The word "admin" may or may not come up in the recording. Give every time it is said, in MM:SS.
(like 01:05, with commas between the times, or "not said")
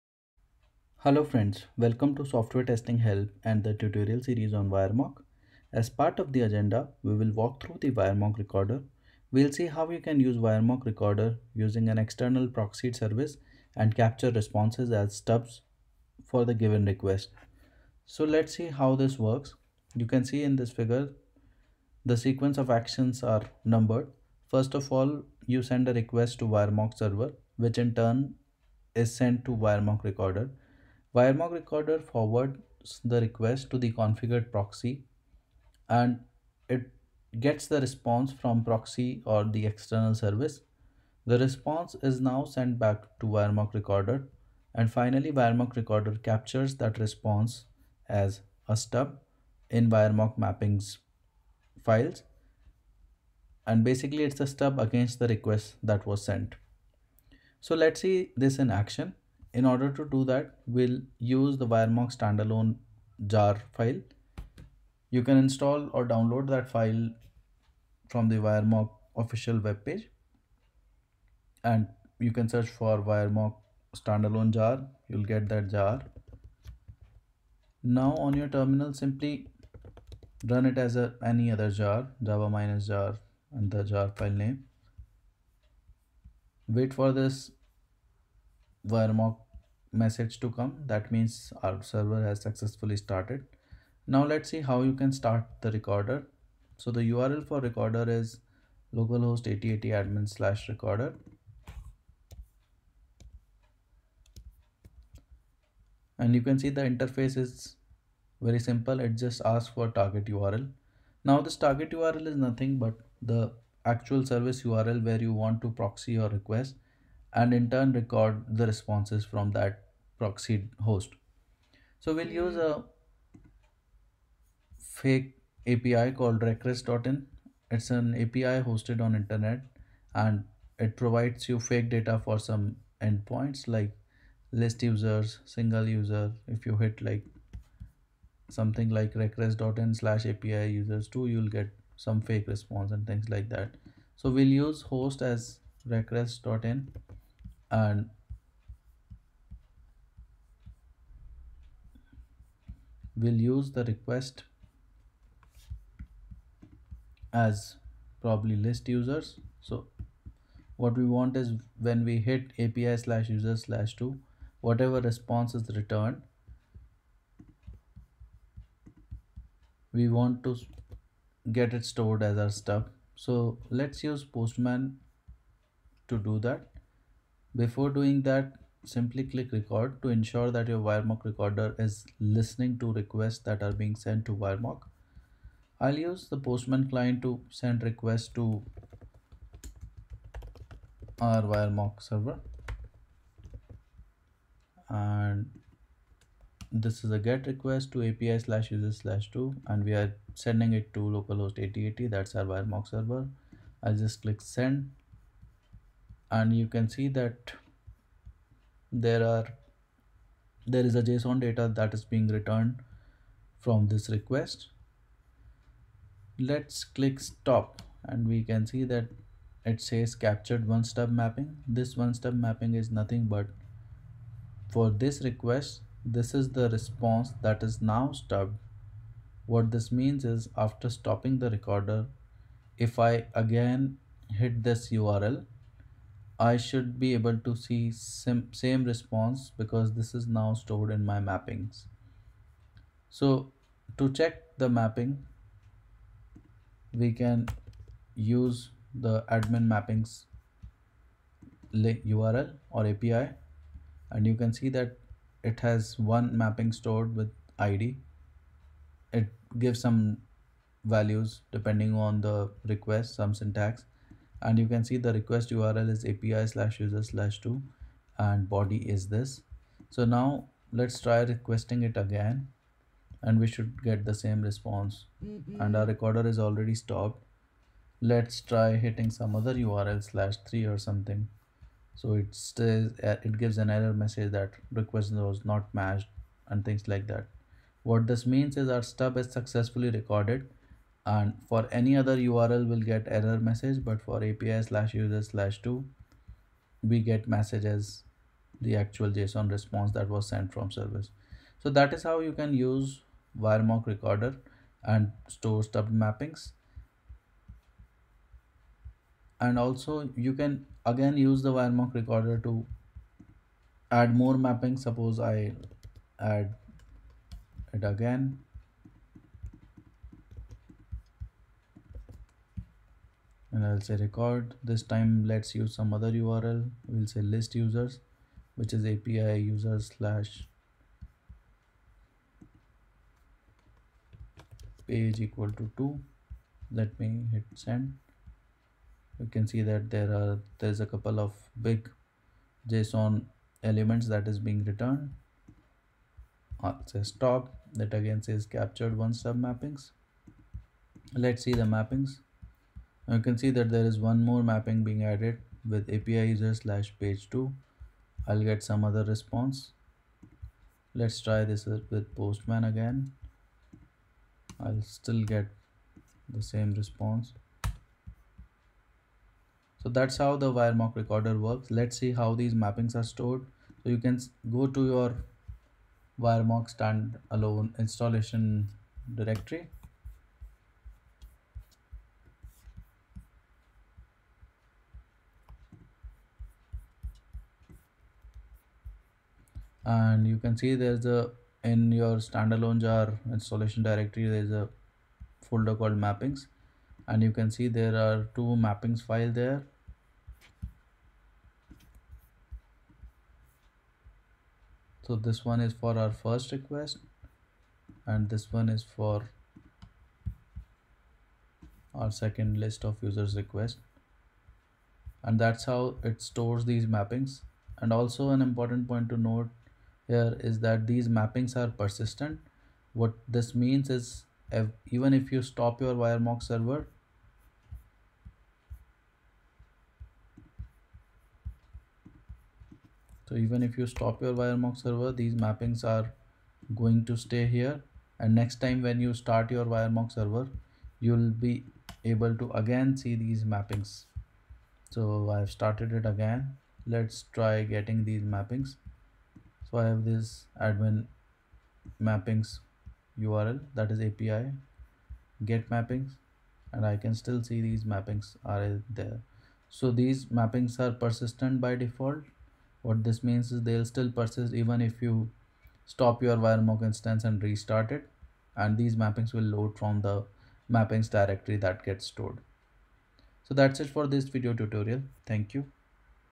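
01:40, 04:09, 07:30.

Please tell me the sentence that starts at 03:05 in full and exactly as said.
I'll use the Postman client to send requests to our WireMock server.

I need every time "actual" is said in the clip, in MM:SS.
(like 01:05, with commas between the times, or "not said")
01:53, 04:58.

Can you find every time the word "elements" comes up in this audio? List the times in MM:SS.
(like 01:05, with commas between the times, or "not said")
05:43.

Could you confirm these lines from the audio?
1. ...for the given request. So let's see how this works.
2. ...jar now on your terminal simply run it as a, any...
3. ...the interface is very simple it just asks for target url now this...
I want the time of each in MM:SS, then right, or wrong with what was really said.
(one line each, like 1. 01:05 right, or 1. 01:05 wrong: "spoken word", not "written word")
1. 00:16 right
2. 01:15 right
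3. 01:46 right.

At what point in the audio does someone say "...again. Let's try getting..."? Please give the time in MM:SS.
07:26.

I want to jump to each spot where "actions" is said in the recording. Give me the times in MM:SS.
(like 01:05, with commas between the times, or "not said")
00:22, 00:58.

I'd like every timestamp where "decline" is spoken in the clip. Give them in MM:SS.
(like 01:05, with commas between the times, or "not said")
not said.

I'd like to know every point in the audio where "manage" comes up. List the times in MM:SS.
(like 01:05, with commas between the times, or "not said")
not said.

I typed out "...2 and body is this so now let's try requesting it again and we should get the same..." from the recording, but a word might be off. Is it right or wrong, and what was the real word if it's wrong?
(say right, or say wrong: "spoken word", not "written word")
right.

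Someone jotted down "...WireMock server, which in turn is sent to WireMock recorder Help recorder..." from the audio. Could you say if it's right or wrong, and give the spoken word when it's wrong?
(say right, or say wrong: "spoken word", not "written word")
wrong: "WireMock", not "Help".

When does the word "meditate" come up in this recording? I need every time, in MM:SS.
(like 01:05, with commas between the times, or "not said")
not said.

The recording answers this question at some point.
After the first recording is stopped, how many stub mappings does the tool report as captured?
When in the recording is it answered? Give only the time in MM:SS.
03:40.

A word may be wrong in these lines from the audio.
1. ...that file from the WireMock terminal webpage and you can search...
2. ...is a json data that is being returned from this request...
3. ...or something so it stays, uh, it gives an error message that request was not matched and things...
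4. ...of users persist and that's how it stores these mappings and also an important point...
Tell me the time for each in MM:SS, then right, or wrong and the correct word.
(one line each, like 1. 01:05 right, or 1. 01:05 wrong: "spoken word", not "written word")
1. 01:06 wrong: "official", not "terminal"
2. 03:30 right
3. 04:40 right
4. 06:52 wrong: "request", not "persist".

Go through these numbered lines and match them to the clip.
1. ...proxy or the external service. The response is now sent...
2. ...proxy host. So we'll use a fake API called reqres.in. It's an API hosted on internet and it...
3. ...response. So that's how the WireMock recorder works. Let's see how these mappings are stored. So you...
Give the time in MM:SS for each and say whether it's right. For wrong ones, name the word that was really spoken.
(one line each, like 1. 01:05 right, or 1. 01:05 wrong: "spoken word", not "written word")
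1. 00:38 right
2. 02:00 right
3. 06:06 right.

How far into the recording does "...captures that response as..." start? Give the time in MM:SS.
00:46.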